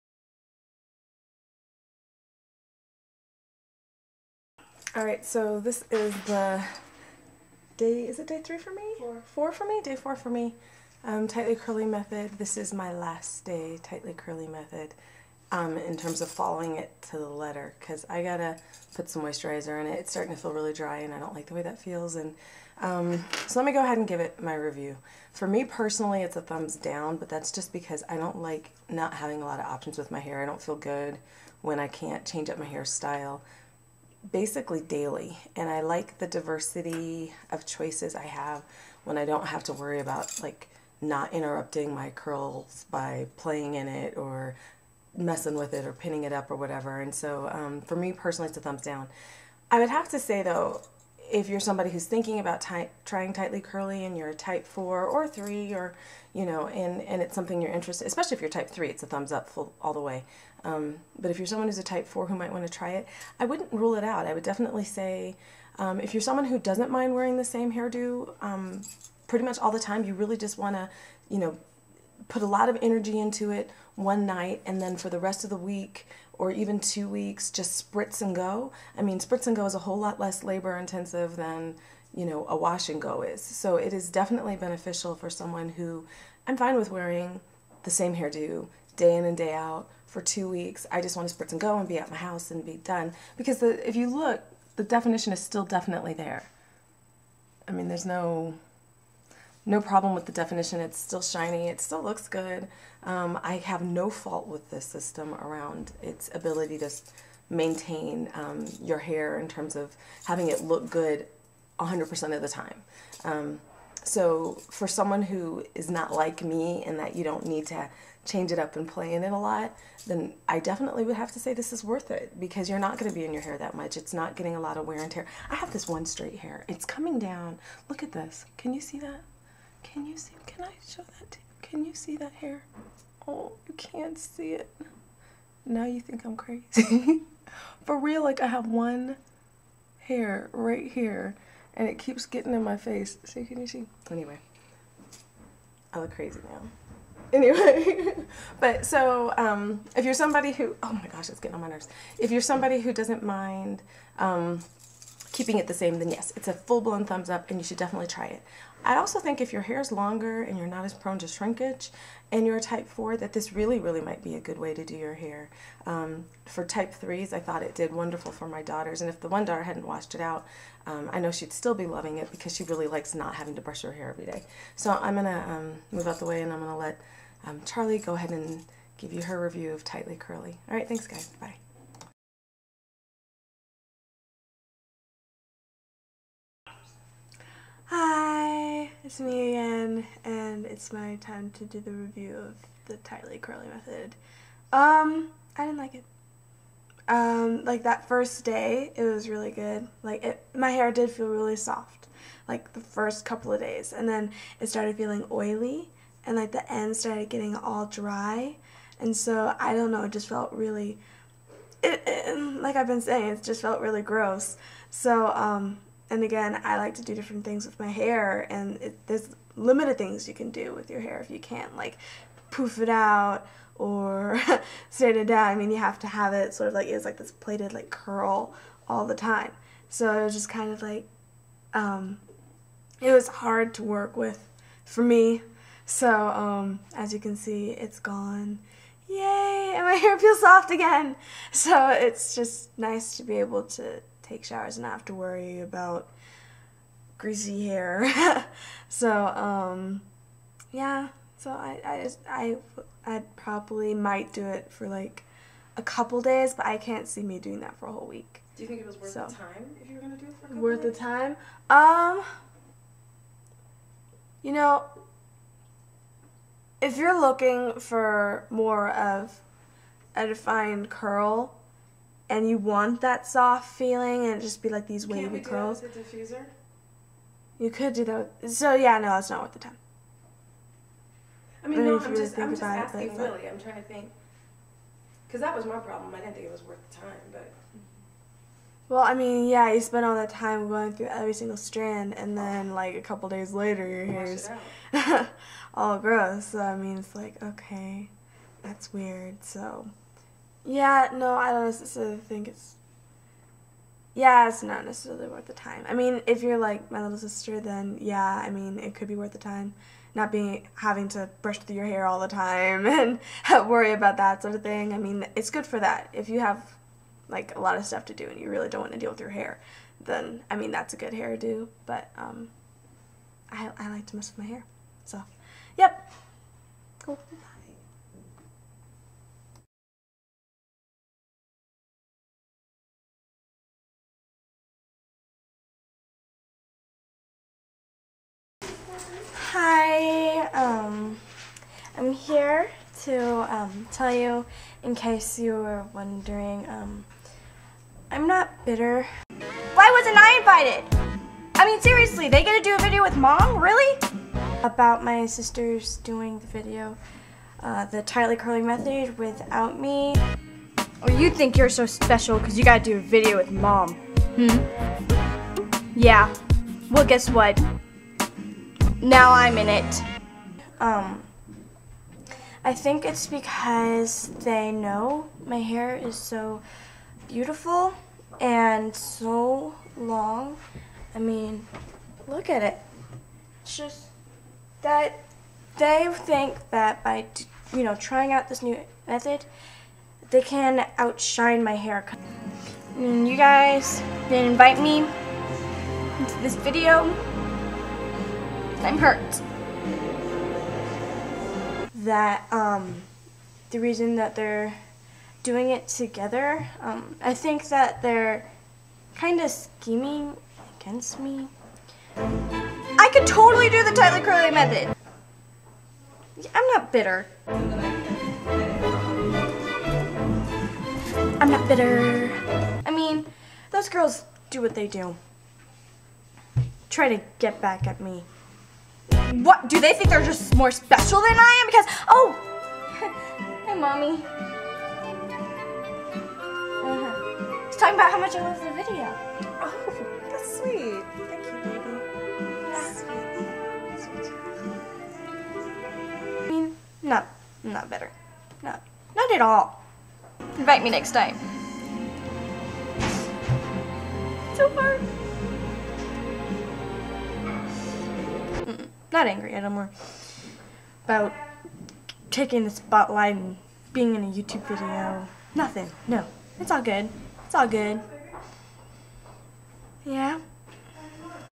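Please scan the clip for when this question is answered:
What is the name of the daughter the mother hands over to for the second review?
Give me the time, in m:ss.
2:57.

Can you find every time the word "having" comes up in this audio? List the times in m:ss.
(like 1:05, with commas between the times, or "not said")
0:29, 1:50, 2:53, 5:10.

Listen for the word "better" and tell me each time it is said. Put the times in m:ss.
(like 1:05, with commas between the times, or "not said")
7:27.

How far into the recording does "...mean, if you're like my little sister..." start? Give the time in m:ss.
5:05.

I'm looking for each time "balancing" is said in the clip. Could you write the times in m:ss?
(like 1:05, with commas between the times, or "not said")
not said.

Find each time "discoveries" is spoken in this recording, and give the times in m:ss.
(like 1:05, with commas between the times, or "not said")
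not said.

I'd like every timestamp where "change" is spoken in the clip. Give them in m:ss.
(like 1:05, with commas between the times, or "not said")
0:32, 1:58.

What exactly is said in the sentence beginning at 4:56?
So I mean, it's like okay, that's weird.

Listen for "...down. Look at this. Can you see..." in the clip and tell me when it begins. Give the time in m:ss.
2:07.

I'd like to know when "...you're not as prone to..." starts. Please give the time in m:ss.
2:40.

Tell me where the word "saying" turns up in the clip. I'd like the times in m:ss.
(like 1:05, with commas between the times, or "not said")
3:33.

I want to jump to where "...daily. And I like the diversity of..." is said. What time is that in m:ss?
0:34.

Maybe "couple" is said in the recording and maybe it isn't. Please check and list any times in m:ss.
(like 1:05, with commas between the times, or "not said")
3:23, 4:15, 4:20, 4:53.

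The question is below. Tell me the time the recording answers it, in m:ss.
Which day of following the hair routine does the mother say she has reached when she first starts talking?
0:09.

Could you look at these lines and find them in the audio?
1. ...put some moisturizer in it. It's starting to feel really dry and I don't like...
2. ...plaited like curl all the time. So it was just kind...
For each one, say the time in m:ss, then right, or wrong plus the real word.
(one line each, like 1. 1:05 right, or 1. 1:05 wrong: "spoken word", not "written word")
1. 0:18 right
2. 3:47 right.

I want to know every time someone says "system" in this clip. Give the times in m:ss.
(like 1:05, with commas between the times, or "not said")
1:44.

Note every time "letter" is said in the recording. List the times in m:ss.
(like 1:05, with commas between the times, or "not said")
0:17.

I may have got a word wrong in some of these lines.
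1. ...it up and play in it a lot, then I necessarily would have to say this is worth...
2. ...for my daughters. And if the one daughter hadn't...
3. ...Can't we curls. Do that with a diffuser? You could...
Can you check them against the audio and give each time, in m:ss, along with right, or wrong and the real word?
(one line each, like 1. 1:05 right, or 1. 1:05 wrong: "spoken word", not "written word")
1. 1:58 wrong: "definitely", not "necessarily"
2. 2:48 right
3. 4:35 right.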